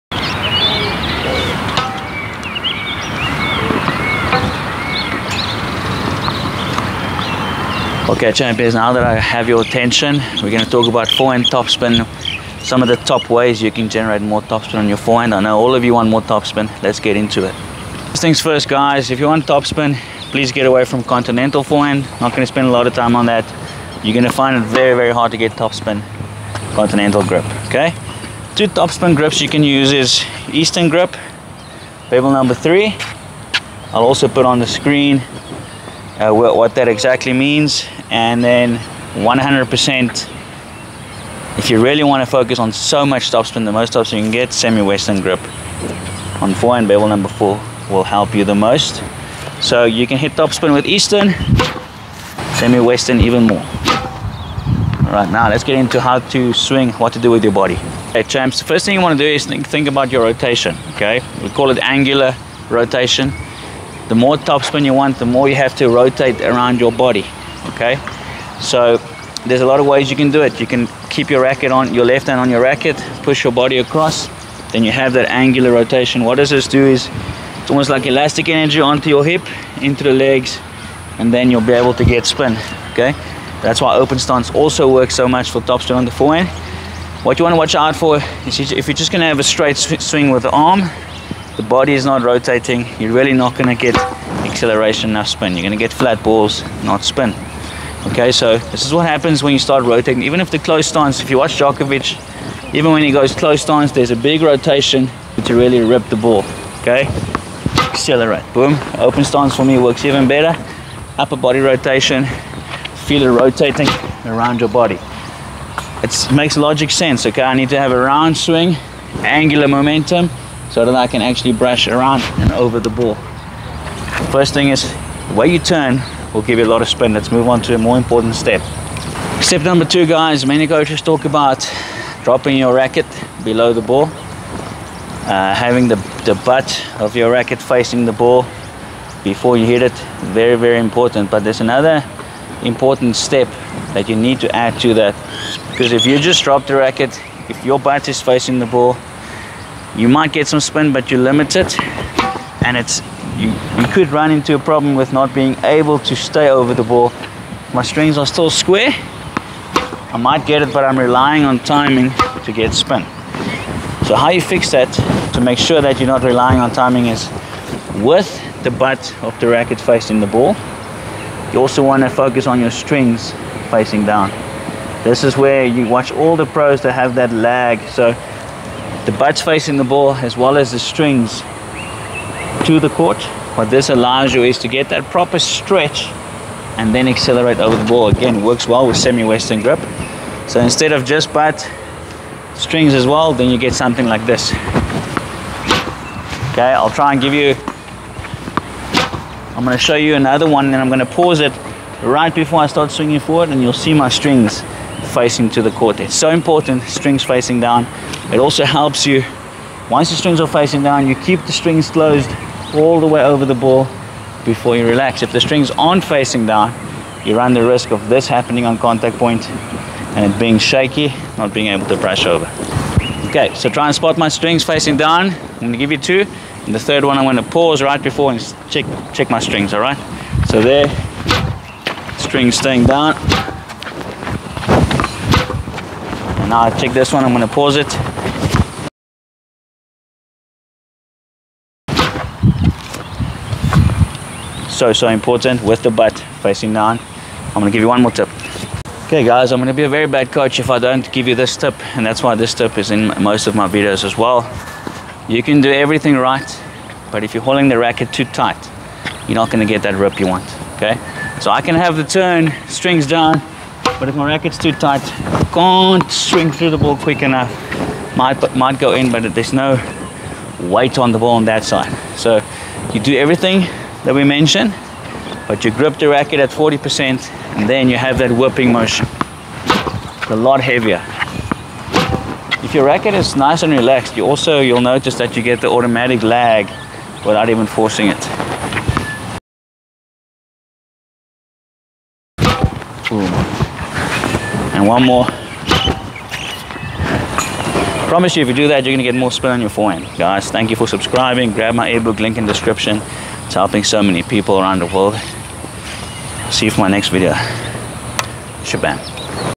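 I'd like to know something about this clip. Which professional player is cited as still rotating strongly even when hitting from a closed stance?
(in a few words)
Djokovic.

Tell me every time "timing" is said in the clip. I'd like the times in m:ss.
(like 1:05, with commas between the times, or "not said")
2:41, 2:46.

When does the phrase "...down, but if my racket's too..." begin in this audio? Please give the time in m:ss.
4:23.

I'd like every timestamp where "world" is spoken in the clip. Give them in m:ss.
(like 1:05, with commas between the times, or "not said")
5:04.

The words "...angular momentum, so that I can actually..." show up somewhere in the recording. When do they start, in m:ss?
1:59.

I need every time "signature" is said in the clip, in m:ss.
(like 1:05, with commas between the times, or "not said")
not said.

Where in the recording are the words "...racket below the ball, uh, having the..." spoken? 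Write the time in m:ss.
2:12.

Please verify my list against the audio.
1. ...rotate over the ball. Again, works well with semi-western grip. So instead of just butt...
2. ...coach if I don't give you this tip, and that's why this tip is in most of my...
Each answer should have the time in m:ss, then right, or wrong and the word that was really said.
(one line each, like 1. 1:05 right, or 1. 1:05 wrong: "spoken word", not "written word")
1. 3:07 wrong: "accelerate", not "rotate"
2. 4:10 right.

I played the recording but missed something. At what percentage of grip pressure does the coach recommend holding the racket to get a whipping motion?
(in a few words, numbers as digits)
40%.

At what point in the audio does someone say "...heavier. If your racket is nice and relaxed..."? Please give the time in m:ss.
4:40.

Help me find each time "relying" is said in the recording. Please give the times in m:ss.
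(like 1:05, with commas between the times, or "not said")
2:40, 2:46.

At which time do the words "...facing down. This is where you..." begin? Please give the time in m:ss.
2:53.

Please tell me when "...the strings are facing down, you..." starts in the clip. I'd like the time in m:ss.
3:30.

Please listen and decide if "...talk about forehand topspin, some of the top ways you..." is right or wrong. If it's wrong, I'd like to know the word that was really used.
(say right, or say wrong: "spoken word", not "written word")
right.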